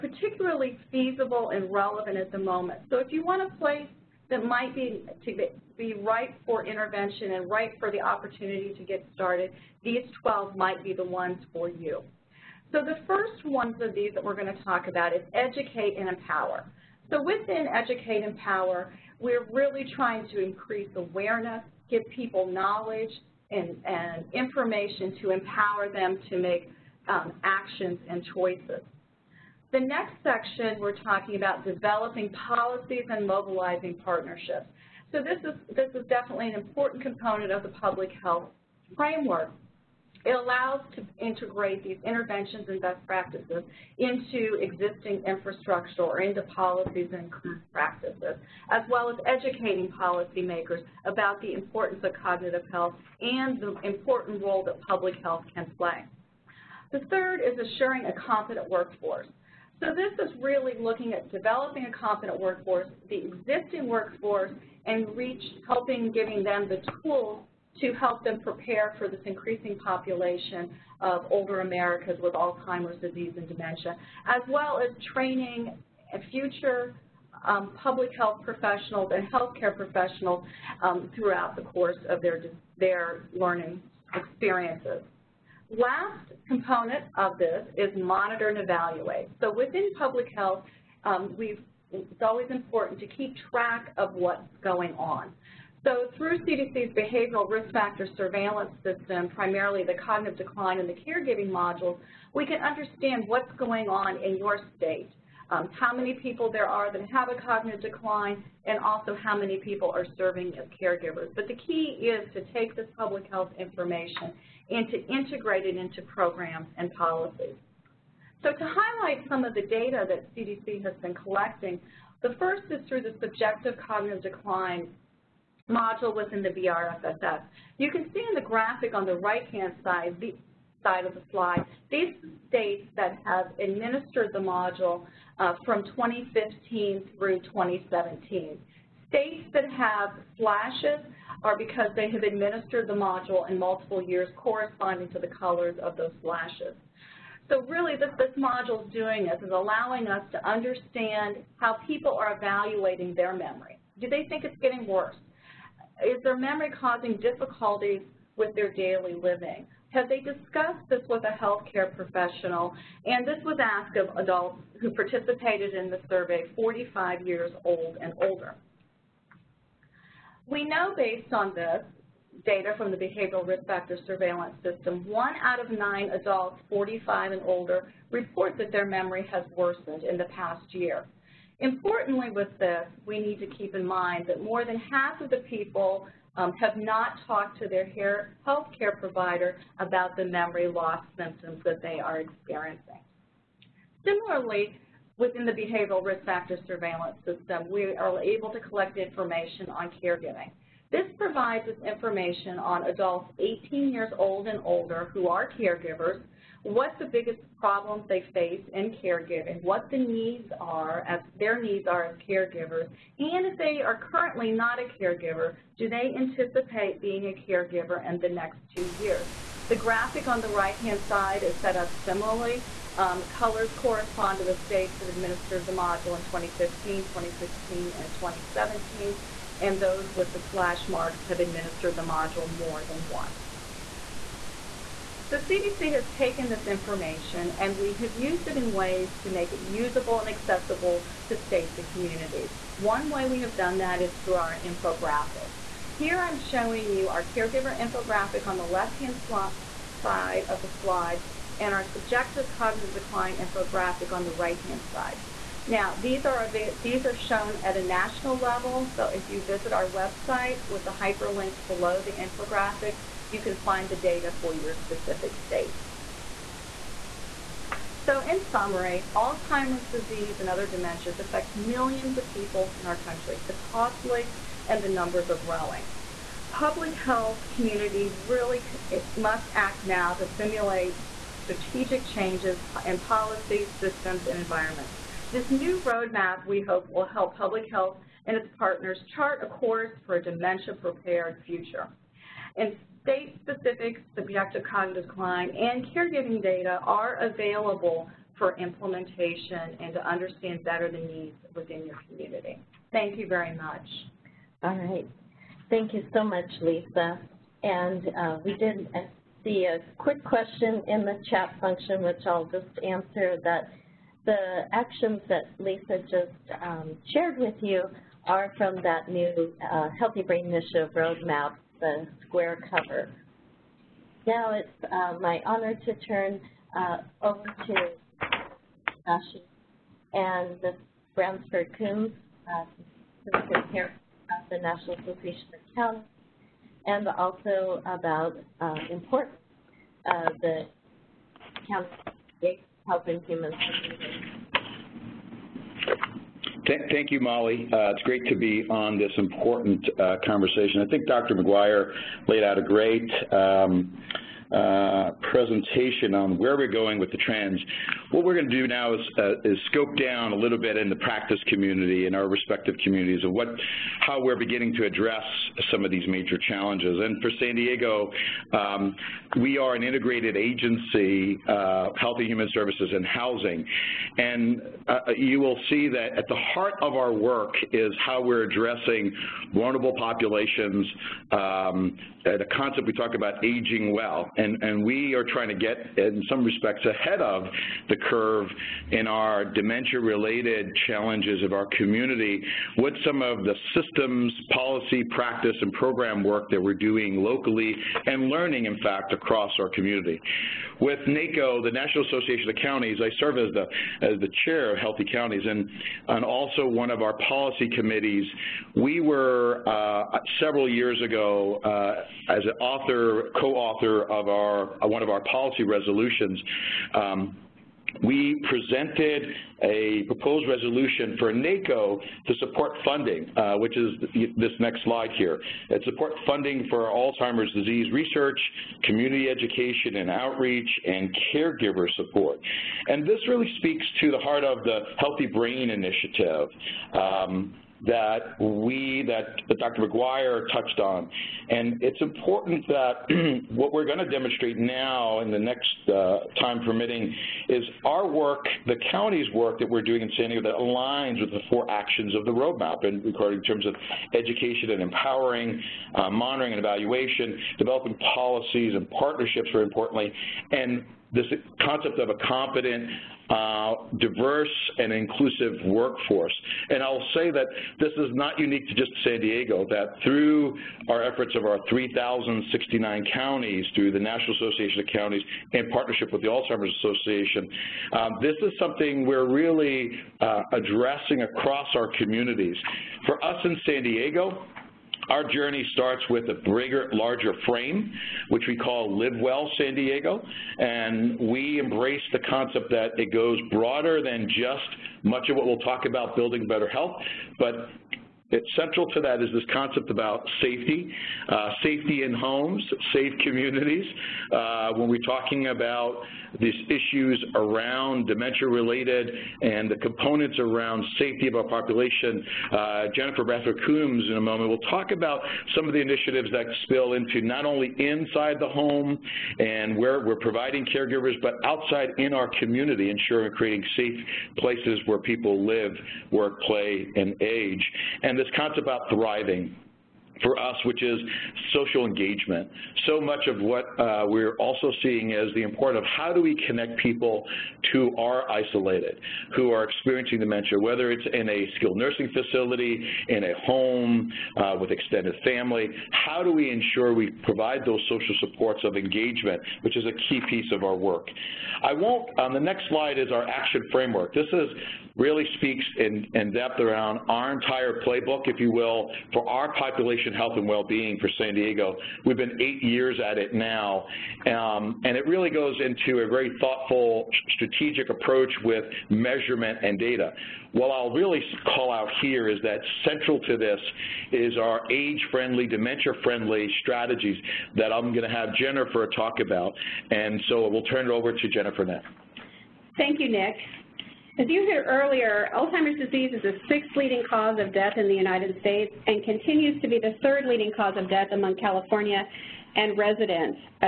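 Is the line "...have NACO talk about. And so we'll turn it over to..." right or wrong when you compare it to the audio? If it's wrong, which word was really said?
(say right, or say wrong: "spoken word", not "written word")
wrong: "Jennifer", not "NACO".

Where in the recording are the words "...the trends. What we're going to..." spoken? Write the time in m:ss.
5:57.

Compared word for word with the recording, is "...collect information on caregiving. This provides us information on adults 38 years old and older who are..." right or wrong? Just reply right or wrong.
wrong.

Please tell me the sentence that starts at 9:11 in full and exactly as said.
I won't, on the next slide is our action framework.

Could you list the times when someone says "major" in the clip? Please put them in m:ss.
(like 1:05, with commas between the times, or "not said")
6:06.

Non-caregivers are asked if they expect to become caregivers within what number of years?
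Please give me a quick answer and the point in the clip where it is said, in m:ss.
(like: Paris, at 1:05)
2 years, at 3:38.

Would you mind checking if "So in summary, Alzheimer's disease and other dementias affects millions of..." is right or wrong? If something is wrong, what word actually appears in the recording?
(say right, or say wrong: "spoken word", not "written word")
right.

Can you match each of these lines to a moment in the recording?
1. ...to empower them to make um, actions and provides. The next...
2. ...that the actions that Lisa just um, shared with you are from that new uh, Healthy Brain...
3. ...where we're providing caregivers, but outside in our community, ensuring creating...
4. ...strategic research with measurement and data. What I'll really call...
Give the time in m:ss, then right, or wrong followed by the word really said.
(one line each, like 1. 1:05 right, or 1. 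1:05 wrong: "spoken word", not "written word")
1. 0:25 wrong: "choices", not "provides"
2. 5:13 right
3. 8:39 right
4. 9:27 wrong: "approach", not "research".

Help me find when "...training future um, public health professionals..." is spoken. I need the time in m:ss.
1:15.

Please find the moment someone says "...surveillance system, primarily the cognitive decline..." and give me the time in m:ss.
1:38.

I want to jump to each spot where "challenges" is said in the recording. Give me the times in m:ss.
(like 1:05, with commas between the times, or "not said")
6:06, 6:30.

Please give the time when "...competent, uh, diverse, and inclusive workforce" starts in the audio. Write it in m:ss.
7:42.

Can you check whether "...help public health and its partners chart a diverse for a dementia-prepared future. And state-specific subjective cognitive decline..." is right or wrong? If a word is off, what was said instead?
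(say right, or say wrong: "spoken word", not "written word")
wrong: "course", not "diverse".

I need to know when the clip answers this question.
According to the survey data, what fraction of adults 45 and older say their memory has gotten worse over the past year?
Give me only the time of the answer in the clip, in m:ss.
2:55.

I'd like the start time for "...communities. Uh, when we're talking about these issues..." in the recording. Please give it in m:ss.
8:23.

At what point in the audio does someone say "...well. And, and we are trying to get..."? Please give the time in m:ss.
6:23.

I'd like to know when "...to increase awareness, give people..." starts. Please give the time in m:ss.
0:20.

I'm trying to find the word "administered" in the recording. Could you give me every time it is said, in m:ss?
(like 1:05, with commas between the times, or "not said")
2:13, 2:22, 3:45, 3:51.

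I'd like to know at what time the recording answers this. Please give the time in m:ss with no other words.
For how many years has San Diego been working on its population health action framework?
9:22.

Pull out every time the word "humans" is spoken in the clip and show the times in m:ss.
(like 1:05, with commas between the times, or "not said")
5:43, 6:12.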